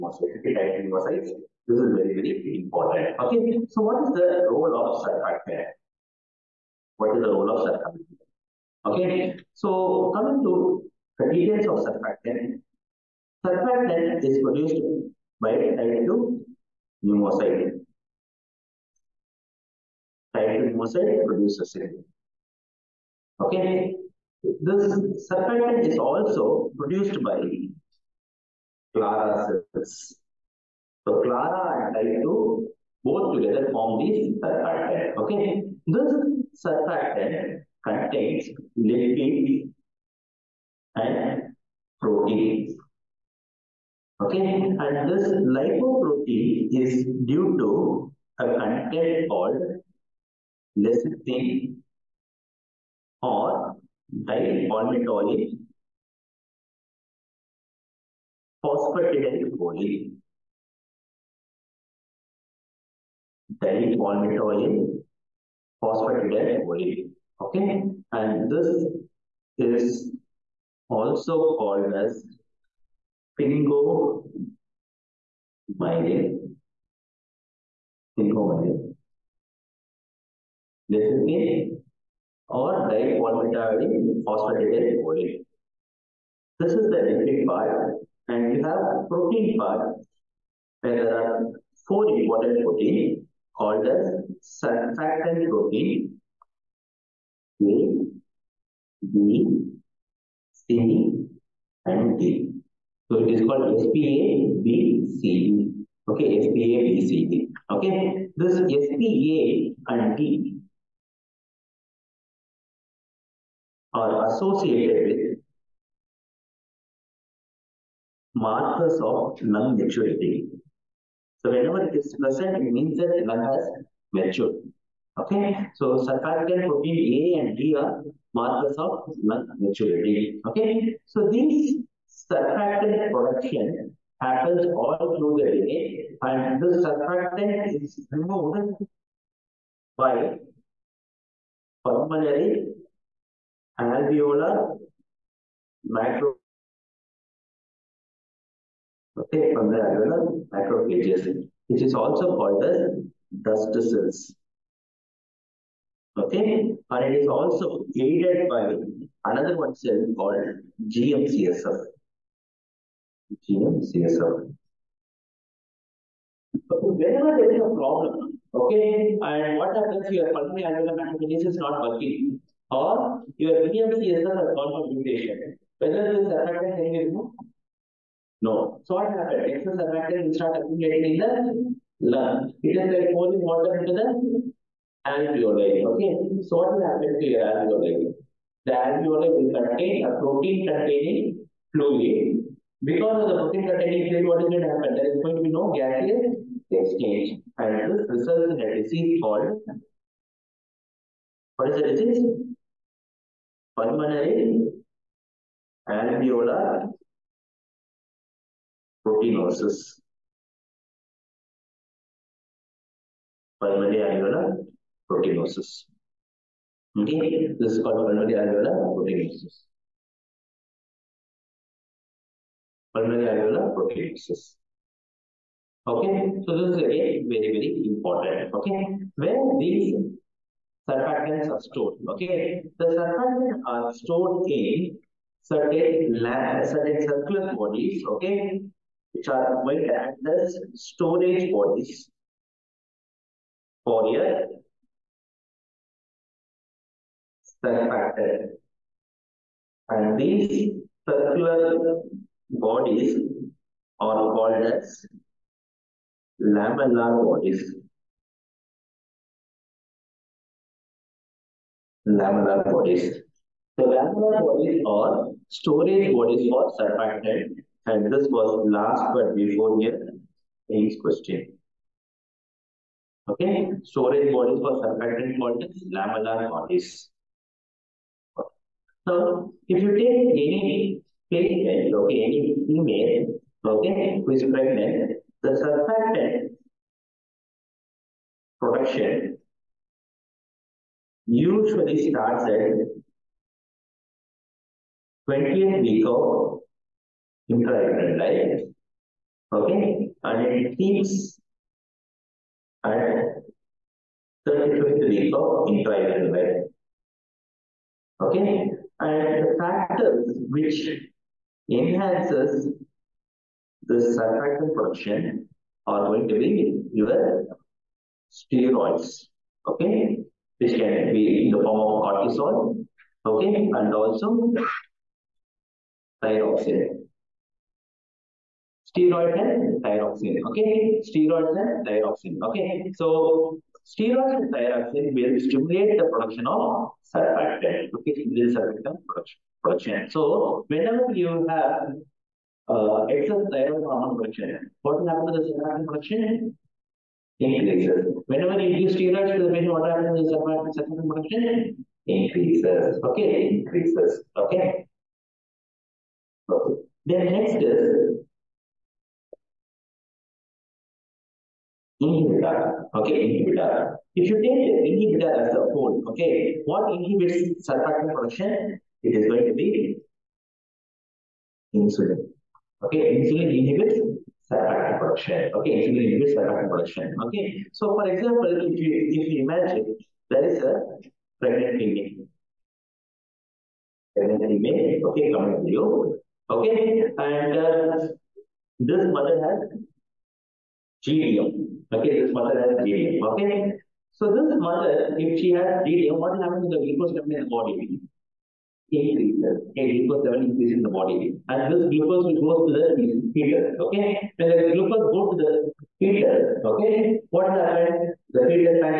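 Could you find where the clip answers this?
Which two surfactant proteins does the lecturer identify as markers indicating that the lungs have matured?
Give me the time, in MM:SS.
01:48.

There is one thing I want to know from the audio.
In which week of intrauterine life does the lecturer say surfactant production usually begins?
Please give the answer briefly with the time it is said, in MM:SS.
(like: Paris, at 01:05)
20th week, at 04:55.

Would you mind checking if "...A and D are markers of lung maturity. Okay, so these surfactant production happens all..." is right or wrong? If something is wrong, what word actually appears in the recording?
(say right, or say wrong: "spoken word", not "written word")
right.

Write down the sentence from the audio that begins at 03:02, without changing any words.
It is like pouring water into the alveoli.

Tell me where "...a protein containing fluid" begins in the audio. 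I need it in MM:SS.
03:10.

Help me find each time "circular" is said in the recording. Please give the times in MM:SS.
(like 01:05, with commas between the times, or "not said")
03:57, 04:11.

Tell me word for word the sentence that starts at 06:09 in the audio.
It is going to be insulin.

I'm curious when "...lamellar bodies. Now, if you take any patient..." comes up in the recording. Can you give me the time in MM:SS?
04:35.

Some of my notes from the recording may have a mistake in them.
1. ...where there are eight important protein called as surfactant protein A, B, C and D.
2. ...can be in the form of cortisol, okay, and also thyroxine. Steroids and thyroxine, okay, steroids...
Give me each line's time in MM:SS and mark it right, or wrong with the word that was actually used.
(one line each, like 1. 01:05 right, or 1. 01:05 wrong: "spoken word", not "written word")
1. 01:30 wrong: "four", not "eight"
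2. 05:20 right.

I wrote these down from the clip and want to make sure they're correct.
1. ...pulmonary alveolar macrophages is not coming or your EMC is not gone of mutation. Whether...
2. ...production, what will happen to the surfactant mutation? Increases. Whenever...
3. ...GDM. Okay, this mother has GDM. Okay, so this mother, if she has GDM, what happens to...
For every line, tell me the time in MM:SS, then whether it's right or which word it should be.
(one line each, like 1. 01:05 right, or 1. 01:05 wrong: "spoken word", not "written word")
1. 02:50 wrong: "working", not "coming"
2. 05:44 wrong: "production", not "mutation"
3. 06:31 right.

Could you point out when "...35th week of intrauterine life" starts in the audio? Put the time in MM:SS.
05:04.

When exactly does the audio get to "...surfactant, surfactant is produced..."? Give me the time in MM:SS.
00:11.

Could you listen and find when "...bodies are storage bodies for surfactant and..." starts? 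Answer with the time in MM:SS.
04:24.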